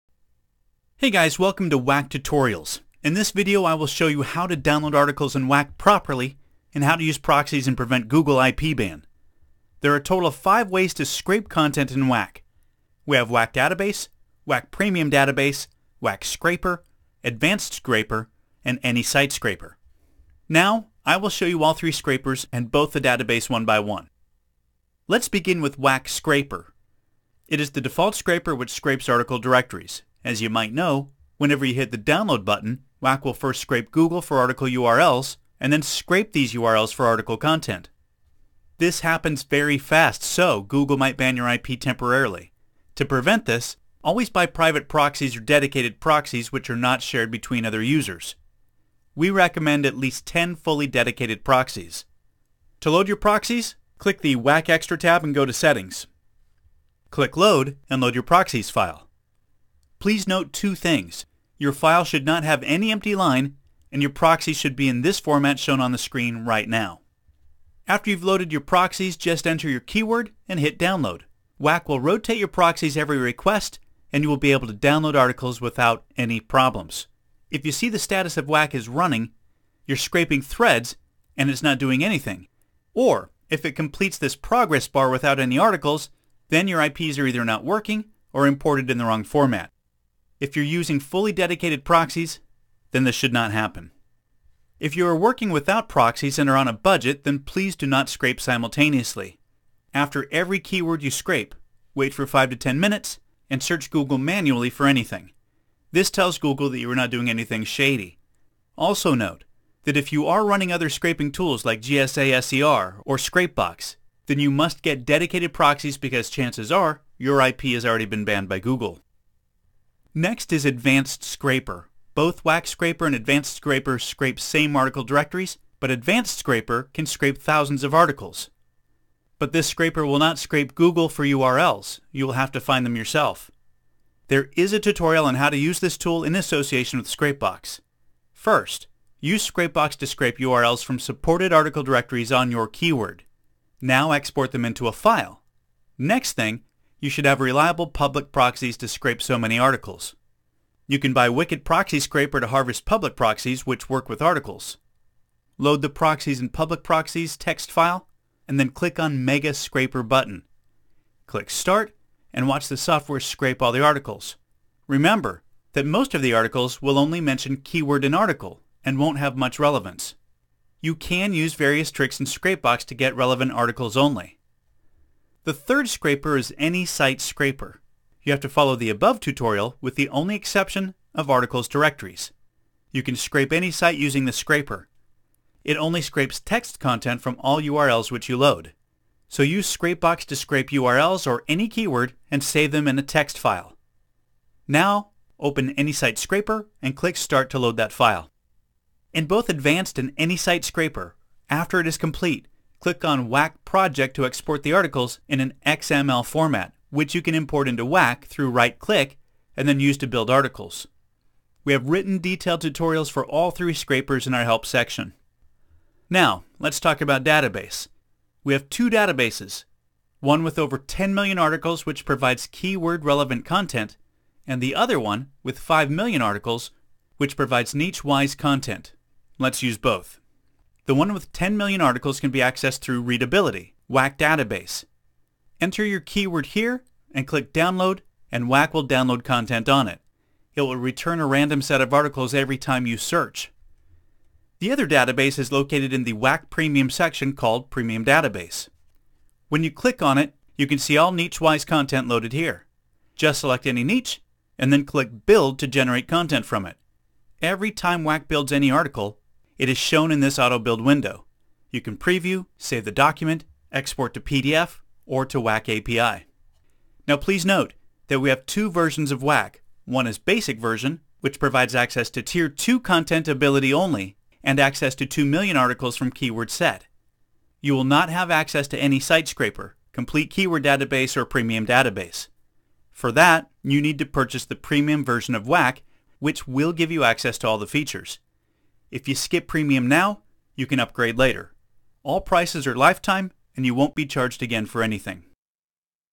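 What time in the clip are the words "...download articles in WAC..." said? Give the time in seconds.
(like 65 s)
4 s.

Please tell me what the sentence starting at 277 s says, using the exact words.
You will not have access to any site scraper, complete keyword database, or premium database.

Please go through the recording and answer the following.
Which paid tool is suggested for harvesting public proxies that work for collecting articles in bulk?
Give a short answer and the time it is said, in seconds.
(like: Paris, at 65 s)
Wicked Proxy Scraper, at 151 s.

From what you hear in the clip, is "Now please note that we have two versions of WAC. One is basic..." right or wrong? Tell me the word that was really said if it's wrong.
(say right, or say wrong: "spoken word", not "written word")
right.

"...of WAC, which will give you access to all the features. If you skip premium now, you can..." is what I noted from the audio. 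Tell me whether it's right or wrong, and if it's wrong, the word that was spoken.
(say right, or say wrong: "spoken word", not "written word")
right.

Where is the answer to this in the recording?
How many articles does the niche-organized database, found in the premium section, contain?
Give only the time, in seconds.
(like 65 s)
225 s.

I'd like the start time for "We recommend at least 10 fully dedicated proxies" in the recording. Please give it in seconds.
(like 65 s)
49 s.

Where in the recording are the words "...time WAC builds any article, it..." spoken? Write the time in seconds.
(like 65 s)
257 s.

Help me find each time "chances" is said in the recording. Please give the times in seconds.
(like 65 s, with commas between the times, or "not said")
116 s.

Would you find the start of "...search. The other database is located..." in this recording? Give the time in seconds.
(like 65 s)
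242 s.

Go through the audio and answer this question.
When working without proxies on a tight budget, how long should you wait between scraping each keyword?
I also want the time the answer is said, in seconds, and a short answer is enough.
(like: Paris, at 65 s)
5 to 10 minutes, at 102 s.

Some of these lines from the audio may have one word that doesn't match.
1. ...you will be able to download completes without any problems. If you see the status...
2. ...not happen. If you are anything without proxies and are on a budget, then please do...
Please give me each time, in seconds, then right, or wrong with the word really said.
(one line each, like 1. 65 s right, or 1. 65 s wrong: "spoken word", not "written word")
1. 74 s wrong: "articles", not "completes"
2. 93 s wrong: "working", not "anything".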